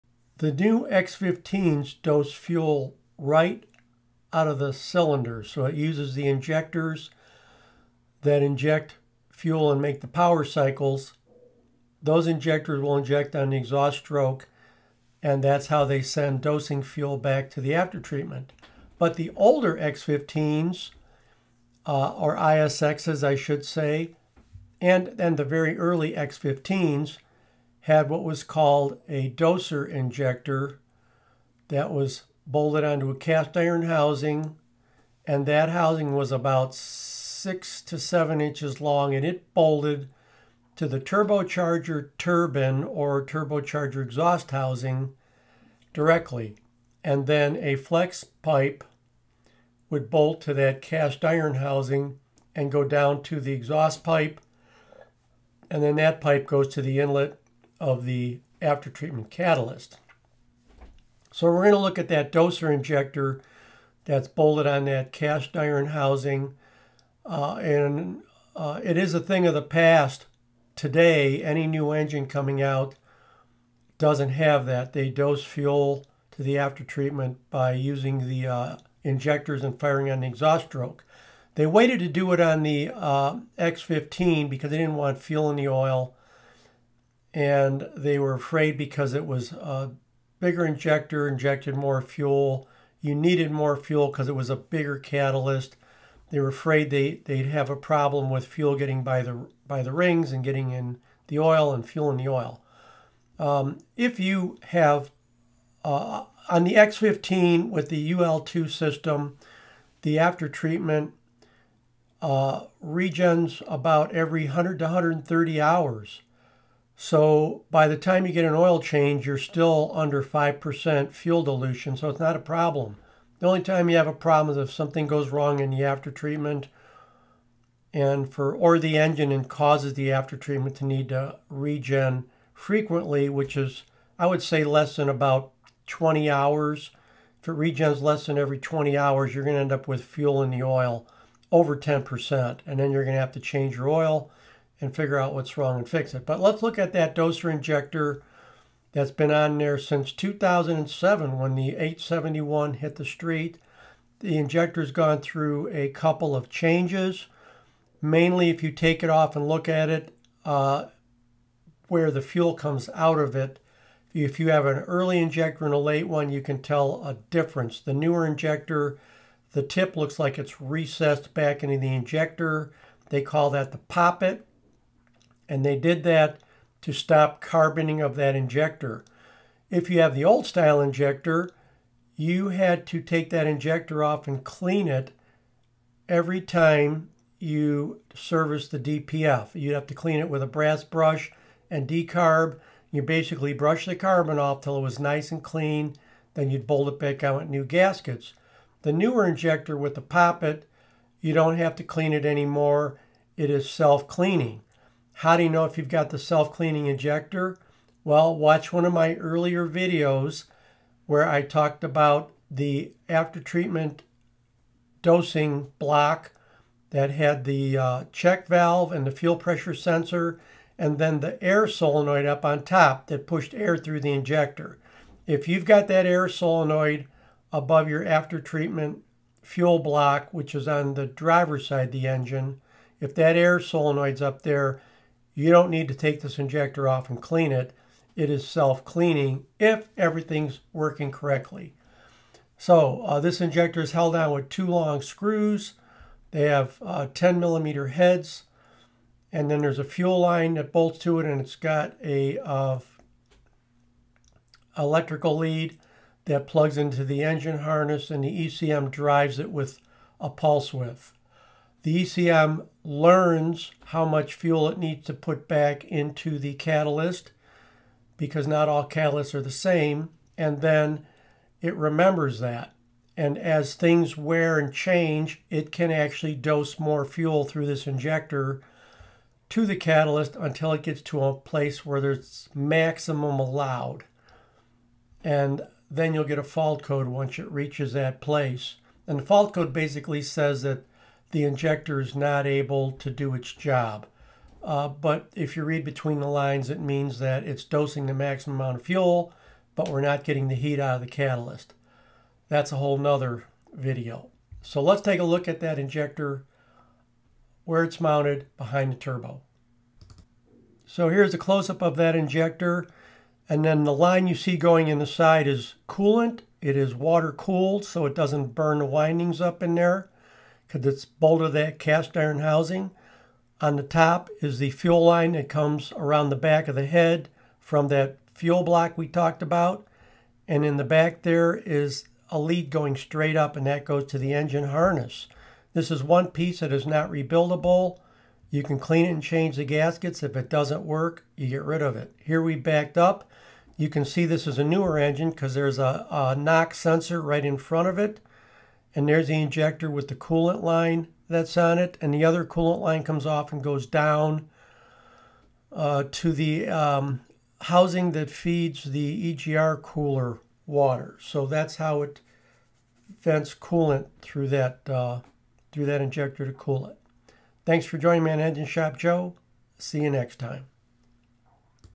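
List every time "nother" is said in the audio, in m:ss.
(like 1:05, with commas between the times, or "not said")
5:02.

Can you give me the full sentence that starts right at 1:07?
Uh, and uh, it is a thing of the past.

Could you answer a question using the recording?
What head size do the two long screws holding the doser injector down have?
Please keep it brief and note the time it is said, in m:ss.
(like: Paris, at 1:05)
10 millimeter, at 4:07.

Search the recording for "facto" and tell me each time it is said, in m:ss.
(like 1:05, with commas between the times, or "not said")
not said.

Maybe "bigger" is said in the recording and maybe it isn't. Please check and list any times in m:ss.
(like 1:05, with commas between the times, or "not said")
1:30, 1:34.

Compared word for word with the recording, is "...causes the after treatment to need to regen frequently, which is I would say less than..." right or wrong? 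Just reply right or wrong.
right.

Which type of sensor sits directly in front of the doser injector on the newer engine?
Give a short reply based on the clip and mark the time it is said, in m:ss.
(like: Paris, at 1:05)
knock sensor, at 5:46.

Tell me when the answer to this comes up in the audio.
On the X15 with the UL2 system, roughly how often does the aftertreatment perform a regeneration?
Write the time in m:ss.
1:54.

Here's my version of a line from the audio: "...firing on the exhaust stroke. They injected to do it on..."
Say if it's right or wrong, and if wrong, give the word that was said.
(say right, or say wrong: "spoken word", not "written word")
wrong: "waited", not "injected".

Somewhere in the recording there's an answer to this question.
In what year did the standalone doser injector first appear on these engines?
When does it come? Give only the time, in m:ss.
2:30.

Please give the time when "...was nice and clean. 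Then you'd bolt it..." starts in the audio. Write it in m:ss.
3:14.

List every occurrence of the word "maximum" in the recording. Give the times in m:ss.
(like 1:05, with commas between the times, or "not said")
4:42, 4:58.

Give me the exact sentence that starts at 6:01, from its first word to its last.
So that's how it vents coolant through that uh, through that injector to cool it.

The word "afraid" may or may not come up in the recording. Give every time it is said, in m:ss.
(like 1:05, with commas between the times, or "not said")
1:28, 1:36.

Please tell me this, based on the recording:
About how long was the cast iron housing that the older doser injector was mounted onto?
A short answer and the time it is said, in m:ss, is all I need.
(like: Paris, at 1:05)
6 to 7 inches, at 0:36.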